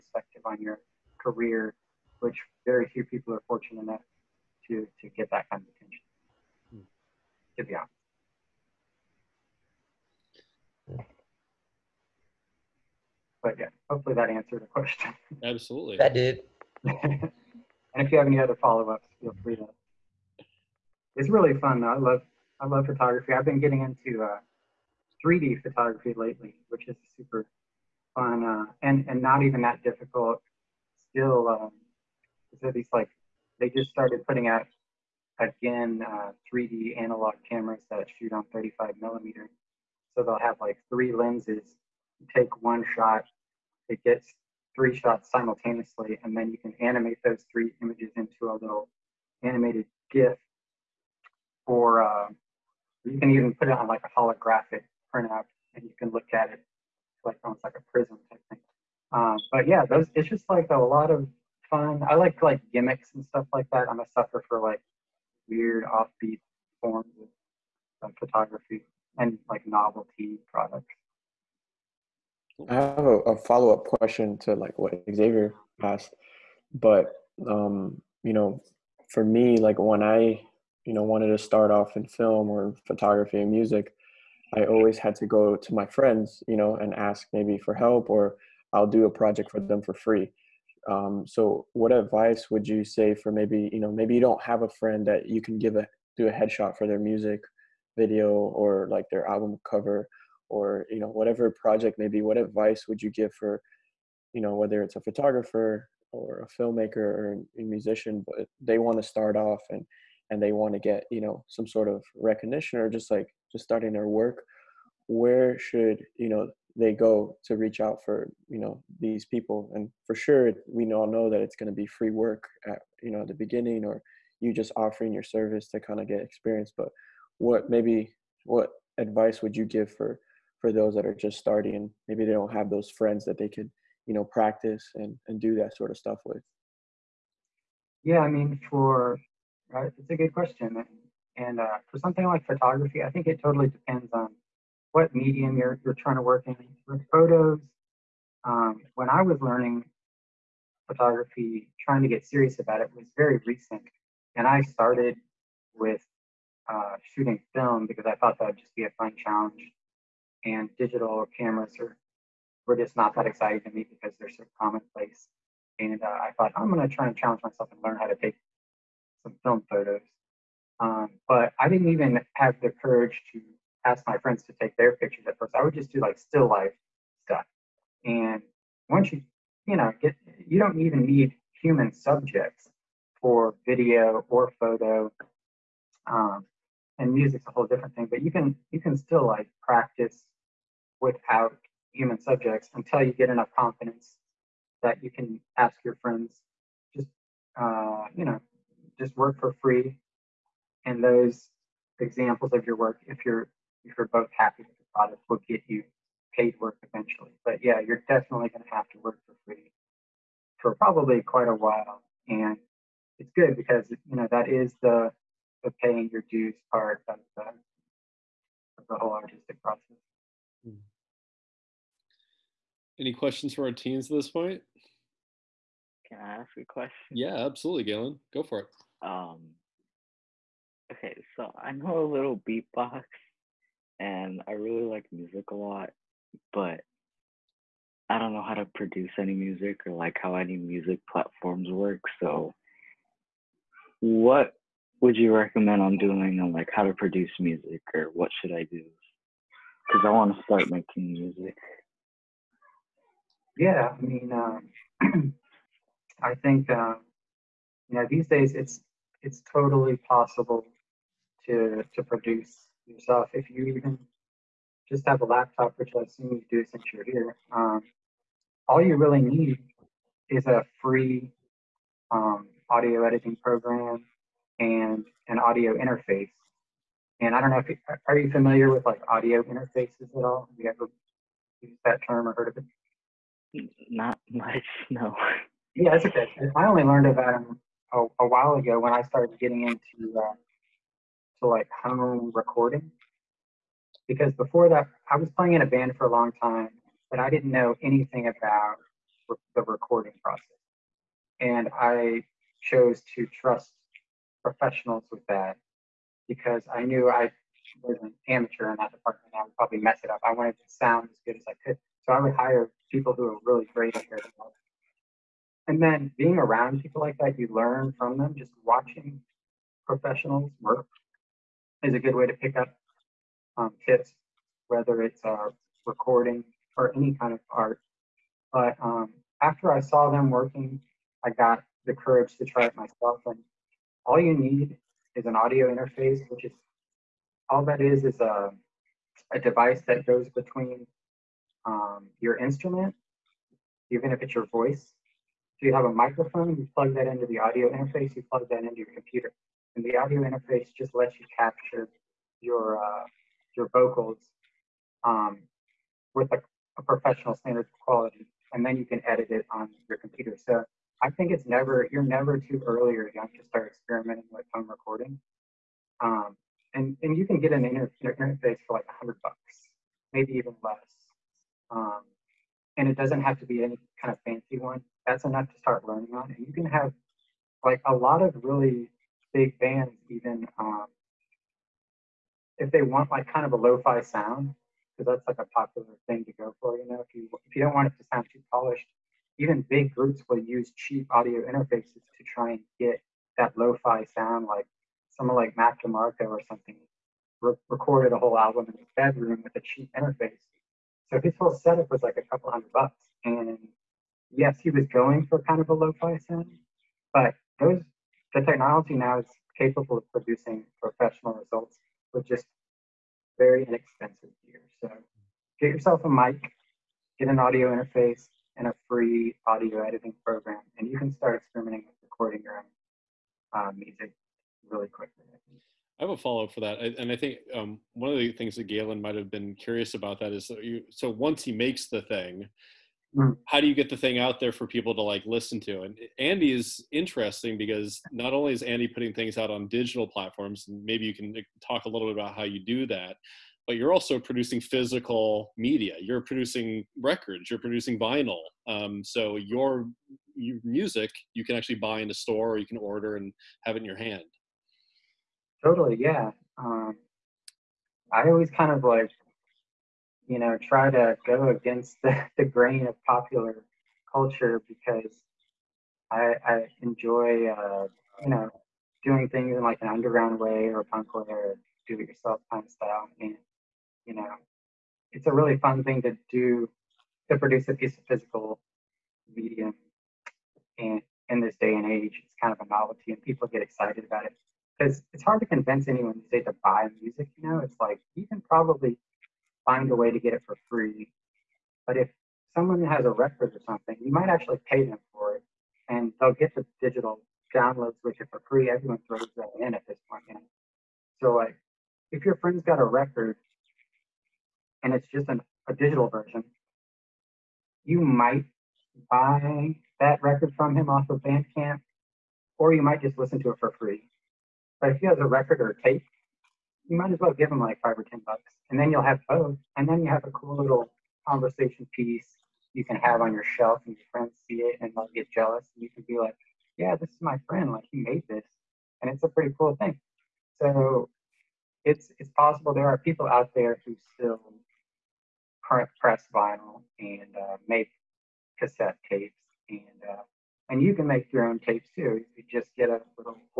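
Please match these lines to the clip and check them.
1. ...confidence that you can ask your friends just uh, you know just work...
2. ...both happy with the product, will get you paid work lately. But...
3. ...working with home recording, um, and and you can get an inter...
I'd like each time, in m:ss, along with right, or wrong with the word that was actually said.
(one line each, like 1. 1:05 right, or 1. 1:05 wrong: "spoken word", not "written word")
1. 3:13 right
2. 3:24 wrong: "eventually", not "lately"
3. 6:03 wrong: "experimenting", not "working".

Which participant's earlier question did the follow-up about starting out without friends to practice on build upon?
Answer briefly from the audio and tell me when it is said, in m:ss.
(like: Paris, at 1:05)
Xavier, at 1:15.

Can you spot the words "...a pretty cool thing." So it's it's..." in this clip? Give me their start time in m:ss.
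8:49.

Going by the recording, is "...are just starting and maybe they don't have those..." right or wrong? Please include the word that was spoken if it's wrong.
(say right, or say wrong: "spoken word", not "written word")
right.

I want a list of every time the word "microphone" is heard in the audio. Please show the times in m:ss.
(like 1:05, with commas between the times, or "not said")
5:45.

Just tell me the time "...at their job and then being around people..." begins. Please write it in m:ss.
5:13.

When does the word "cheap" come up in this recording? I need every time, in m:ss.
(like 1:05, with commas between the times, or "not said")
6:30, 6:39.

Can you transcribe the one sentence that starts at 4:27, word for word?
Um, all you really need is a free um, audio editing program and an audio interface.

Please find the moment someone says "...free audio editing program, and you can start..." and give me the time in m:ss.
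6:58.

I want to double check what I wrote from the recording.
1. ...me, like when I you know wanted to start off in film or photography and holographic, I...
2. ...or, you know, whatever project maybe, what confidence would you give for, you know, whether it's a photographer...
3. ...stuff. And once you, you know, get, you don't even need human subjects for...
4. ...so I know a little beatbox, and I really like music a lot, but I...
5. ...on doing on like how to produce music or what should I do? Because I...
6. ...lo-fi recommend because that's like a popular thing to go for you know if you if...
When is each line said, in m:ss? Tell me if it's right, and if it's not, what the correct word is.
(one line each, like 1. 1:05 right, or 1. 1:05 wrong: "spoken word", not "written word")
1. 1:19 wrong: "music", not "holographic"
2. 1:40 wrong: "advice", not "confidence"
3. 2:57 right
4. 3:51 right
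5. 4:05 right
6. 6:23 wrong: "sound", not "recommend".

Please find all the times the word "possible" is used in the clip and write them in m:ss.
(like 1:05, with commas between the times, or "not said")
4:19, 8:52.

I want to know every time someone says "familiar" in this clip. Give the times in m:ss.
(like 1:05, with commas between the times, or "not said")
4:38.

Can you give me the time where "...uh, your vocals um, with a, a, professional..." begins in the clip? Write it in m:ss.
5:52.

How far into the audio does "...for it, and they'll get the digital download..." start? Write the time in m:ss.
8:15.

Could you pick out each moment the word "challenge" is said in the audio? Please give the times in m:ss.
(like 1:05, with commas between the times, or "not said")
2:39, 2:47.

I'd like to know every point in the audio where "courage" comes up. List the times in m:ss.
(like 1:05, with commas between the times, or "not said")
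2:52, 5:31.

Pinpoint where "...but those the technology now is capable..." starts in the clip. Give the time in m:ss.
6:47.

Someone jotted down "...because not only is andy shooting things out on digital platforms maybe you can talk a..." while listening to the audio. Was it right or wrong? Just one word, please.
wrong.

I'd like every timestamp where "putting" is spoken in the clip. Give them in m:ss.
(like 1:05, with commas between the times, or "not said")
0:34, 7:18.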